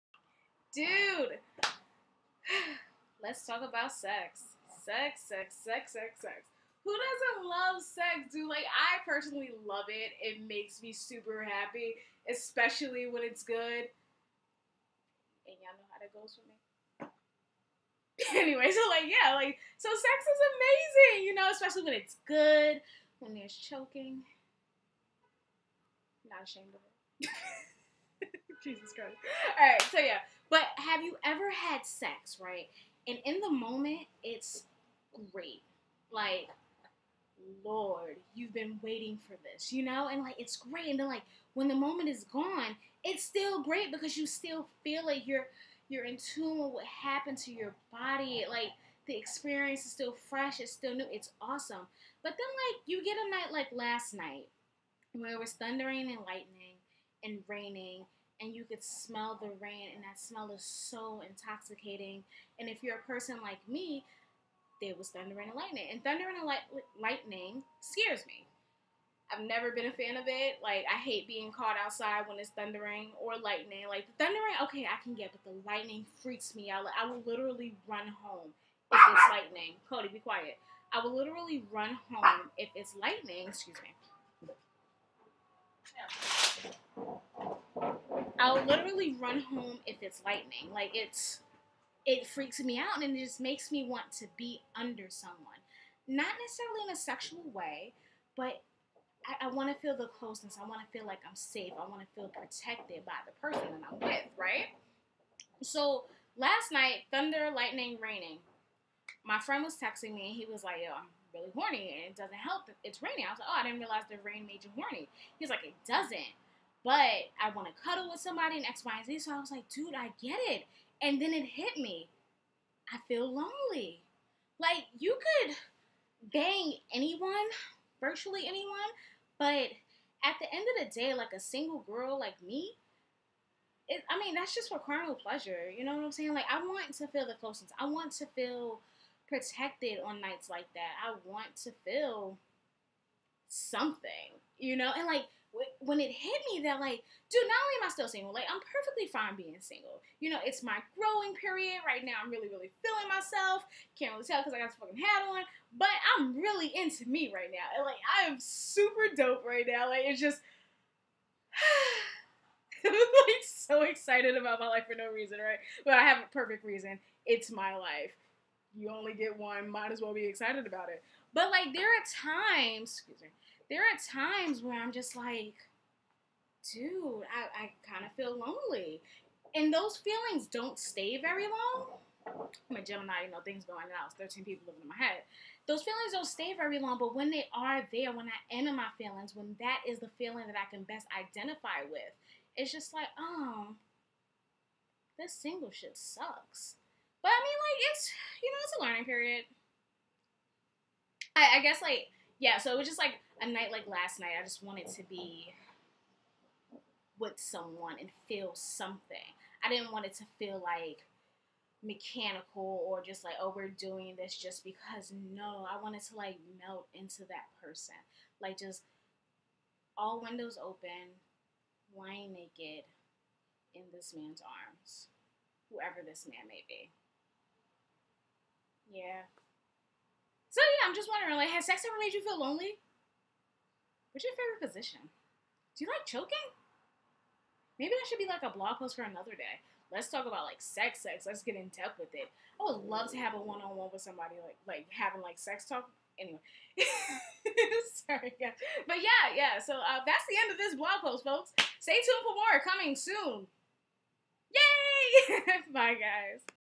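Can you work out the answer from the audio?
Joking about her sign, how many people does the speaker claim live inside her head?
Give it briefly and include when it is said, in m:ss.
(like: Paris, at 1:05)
13, at 3:04.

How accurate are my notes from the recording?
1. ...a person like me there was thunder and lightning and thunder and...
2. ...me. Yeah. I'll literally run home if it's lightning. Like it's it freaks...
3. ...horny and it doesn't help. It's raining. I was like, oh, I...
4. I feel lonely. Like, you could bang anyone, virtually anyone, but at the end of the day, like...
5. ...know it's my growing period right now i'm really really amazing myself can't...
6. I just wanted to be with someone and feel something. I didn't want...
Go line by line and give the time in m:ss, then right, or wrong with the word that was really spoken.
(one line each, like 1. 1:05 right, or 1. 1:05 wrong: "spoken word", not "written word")
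1. 1:02 right
2. 1:23 right
3. 1:51 right
4. 2:02 right
5. 2:30 wrong: "feeling", not "amazing"
6. 3:24 right.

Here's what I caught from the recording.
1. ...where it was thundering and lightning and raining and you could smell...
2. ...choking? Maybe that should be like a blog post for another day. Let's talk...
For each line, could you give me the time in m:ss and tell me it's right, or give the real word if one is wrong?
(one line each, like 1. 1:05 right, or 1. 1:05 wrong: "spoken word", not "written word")
1. 0:55 right
2. 3:56 right.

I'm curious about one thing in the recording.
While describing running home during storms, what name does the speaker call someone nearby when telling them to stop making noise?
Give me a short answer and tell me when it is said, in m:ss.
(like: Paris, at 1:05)
Cody, at 1:19.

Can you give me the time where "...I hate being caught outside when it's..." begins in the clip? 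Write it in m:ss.
1:10.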